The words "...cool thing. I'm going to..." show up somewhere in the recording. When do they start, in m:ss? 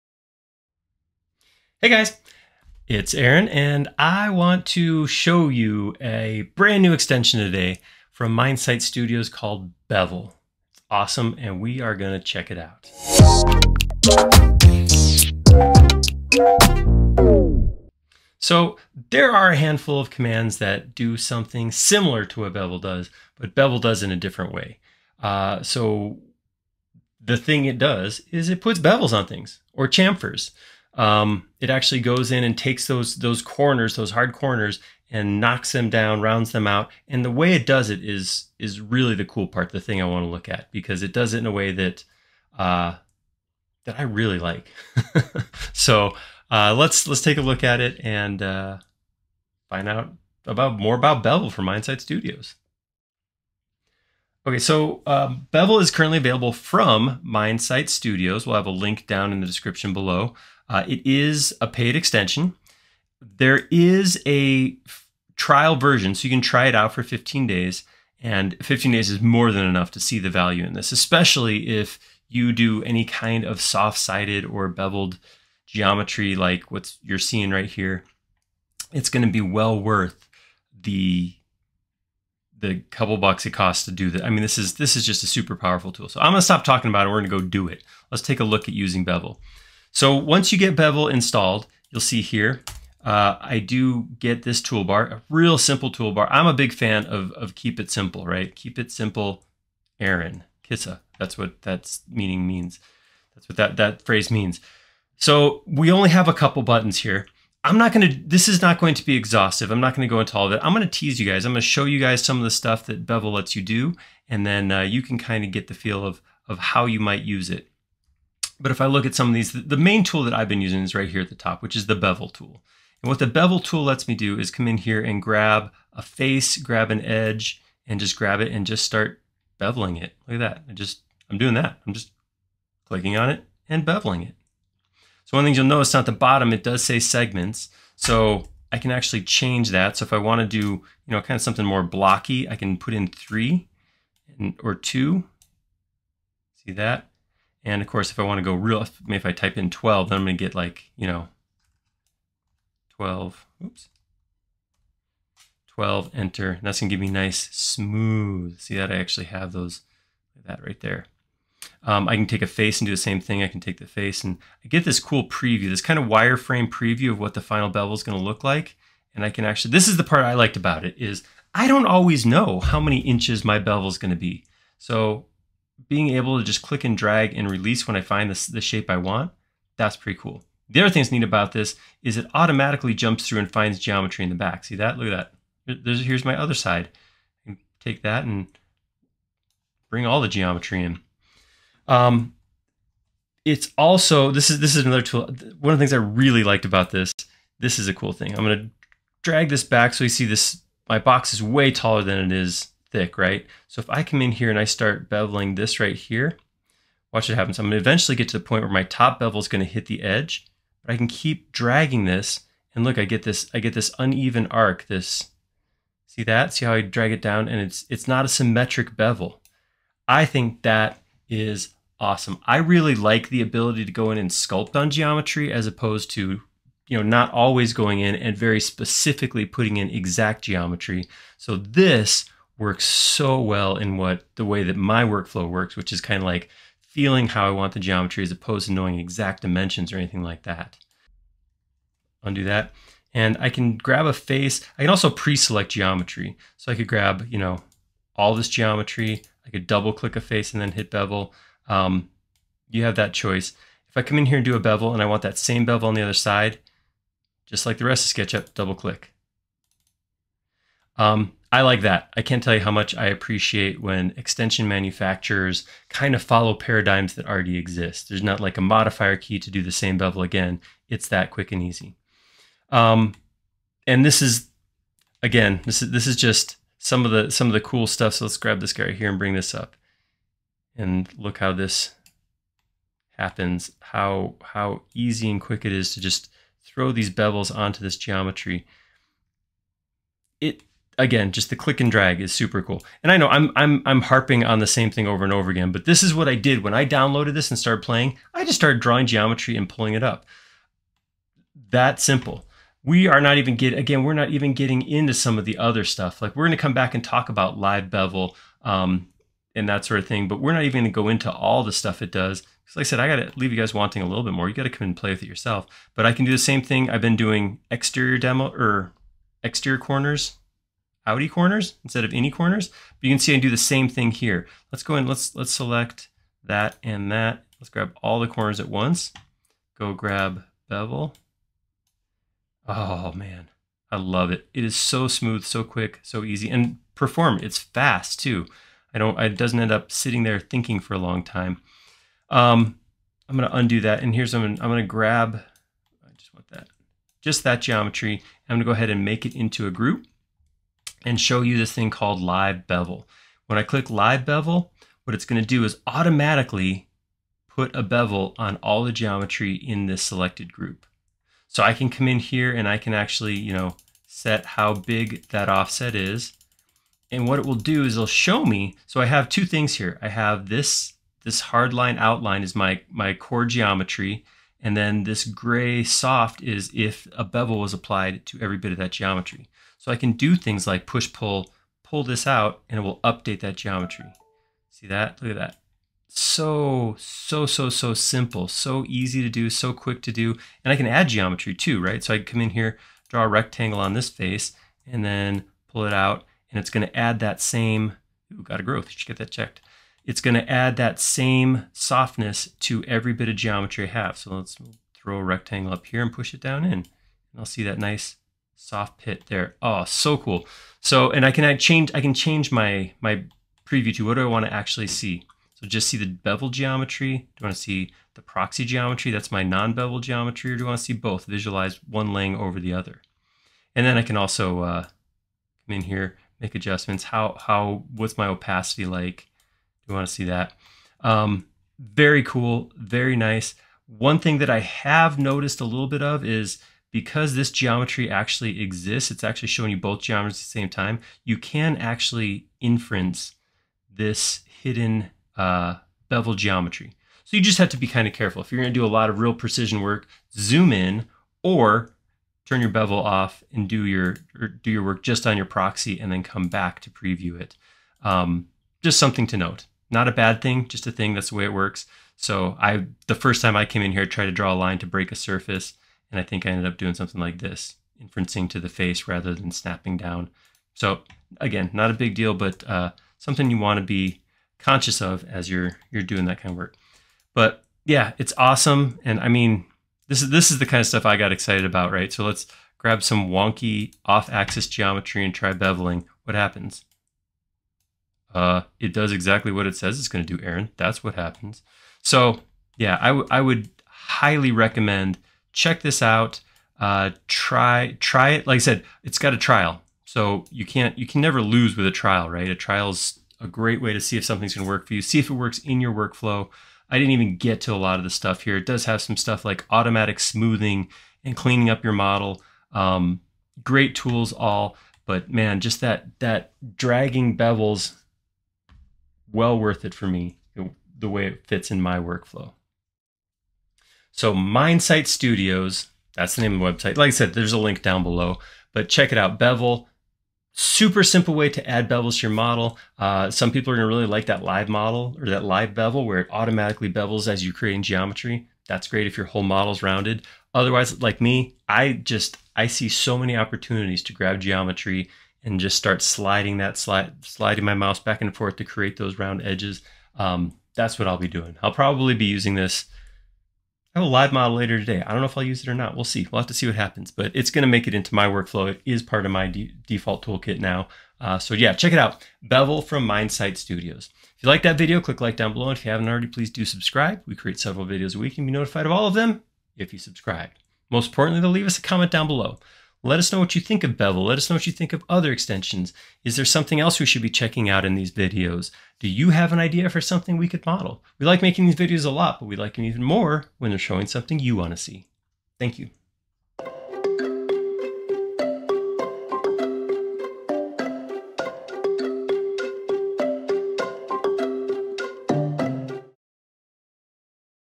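3:17.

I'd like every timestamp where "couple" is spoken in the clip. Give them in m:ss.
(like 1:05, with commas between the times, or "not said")
1:22, 1:46.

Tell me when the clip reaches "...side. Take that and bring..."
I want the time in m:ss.
3:06.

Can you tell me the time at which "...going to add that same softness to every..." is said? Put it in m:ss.
6:40.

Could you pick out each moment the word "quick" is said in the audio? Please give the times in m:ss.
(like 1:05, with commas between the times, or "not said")
4:31, 4:45, 5:35, 6:29.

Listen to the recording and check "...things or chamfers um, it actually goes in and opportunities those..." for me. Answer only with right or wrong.
wrong.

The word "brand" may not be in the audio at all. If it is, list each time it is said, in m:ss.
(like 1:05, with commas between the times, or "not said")
0:06.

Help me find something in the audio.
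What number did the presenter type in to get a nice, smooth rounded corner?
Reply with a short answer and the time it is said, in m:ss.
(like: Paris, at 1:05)
12, at 2:35.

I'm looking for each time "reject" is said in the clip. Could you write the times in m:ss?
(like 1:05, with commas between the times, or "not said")
not said.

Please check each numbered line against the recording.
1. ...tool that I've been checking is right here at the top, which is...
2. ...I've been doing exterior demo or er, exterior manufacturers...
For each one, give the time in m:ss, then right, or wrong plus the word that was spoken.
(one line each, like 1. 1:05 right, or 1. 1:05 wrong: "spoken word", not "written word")
1. 2:00 wrong: "using", not "checking"
2. 5:16 wrong: "corners", not "manufacturers".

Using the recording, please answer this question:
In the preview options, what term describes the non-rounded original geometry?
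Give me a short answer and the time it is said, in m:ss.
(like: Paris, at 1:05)
proxy geometry, at 6:58.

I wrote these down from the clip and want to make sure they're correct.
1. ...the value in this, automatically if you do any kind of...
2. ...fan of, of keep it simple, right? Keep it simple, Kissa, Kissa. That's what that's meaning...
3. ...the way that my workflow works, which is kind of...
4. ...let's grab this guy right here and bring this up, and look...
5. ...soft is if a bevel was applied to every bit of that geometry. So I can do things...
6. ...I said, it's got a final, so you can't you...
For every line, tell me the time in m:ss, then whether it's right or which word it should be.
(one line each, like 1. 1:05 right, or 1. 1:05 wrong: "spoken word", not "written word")
1. 1:10 wrong: "especially", not "automatically"
2. 1:36 wrong: "Aaron", not "Kissa"
3. 3:54 right
4. 4:38 right
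5. 6:15 right
6. 8:18 wrong: "trial", not "final".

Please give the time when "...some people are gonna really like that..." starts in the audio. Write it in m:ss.
8:53.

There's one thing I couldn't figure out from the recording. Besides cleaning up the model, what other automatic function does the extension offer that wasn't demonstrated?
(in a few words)
automatic smoothing.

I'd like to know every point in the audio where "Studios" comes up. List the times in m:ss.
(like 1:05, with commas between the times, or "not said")
0:08, 0:52, 0:57, 8:45, 9:23.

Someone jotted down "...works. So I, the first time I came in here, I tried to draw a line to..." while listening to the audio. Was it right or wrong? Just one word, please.
right.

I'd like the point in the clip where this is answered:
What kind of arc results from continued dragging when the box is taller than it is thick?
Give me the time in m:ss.
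3:33.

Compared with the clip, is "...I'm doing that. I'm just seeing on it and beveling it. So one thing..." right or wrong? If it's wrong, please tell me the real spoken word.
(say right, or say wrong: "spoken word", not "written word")
wrong: "clicking", not "seeing".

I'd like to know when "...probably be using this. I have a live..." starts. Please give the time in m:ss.
9:11.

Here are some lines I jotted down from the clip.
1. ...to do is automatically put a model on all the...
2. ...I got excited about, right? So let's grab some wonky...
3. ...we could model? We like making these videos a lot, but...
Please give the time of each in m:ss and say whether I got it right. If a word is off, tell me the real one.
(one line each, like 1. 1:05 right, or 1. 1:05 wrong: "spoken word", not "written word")
1. 5:55 wrong: "bevel", not "model"
2. 8:01 right
3. 9:40 right.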